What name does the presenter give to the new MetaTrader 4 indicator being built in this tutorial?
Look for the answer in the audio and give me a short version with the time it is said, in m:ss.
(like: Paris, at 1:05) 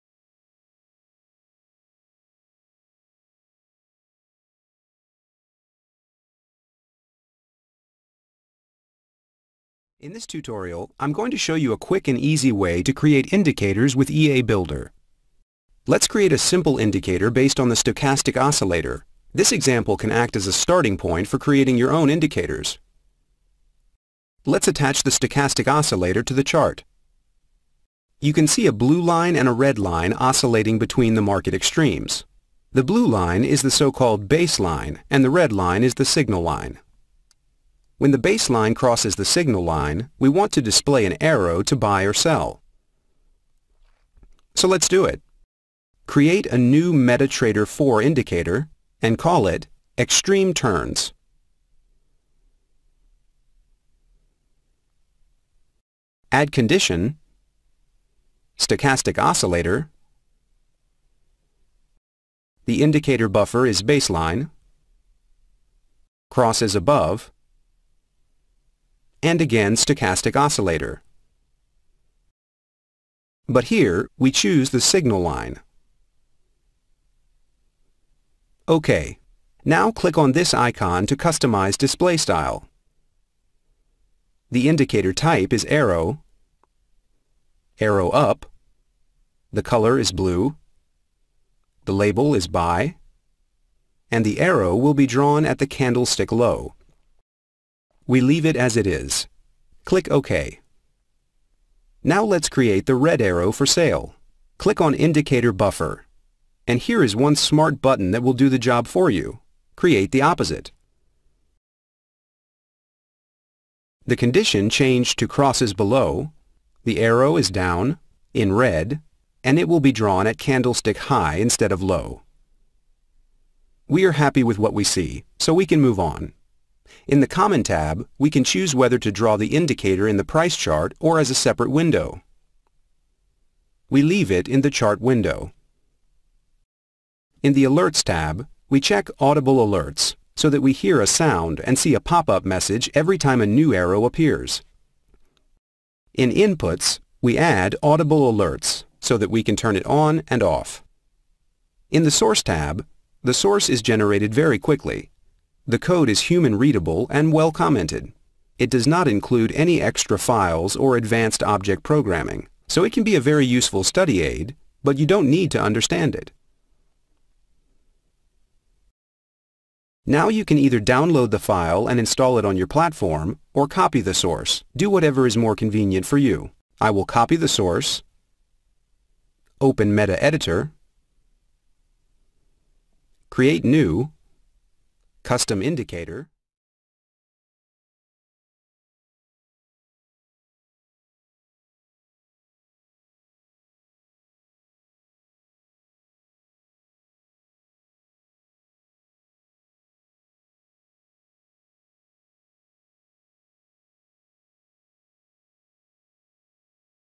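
Extreme Turns, at 0:49.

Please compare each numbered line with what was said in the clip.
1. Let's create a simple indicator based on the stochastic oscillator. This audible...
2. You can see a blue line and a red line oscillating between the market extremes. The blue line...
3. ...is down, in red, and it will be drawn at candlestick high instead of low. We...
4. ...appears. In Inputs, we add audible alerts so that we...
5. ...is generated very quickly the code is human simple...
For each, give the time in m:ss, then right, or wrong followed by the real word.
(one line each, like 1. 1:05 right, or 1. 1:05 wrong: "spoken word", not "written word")
1. 0:15 wrong: "example", not "audible"
2. 0:28 right
3. 1:57 right
4. 2:24 right
5. 2:33 wrong: "readable", not "simple".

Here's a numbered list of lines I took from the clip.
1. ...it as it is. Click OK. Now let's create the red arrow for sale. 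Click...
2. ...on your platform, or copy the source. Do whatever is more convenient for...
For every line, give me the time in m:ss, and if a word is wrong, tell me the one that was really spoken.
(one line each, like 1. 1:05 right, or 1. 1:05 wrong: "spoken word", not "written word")
1. 1:38 right
2. 2:52 right.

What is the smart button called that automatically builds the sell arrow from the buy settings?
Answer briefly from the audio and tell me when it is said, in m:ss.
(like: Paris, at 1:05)
Create the opposite, at 1:49.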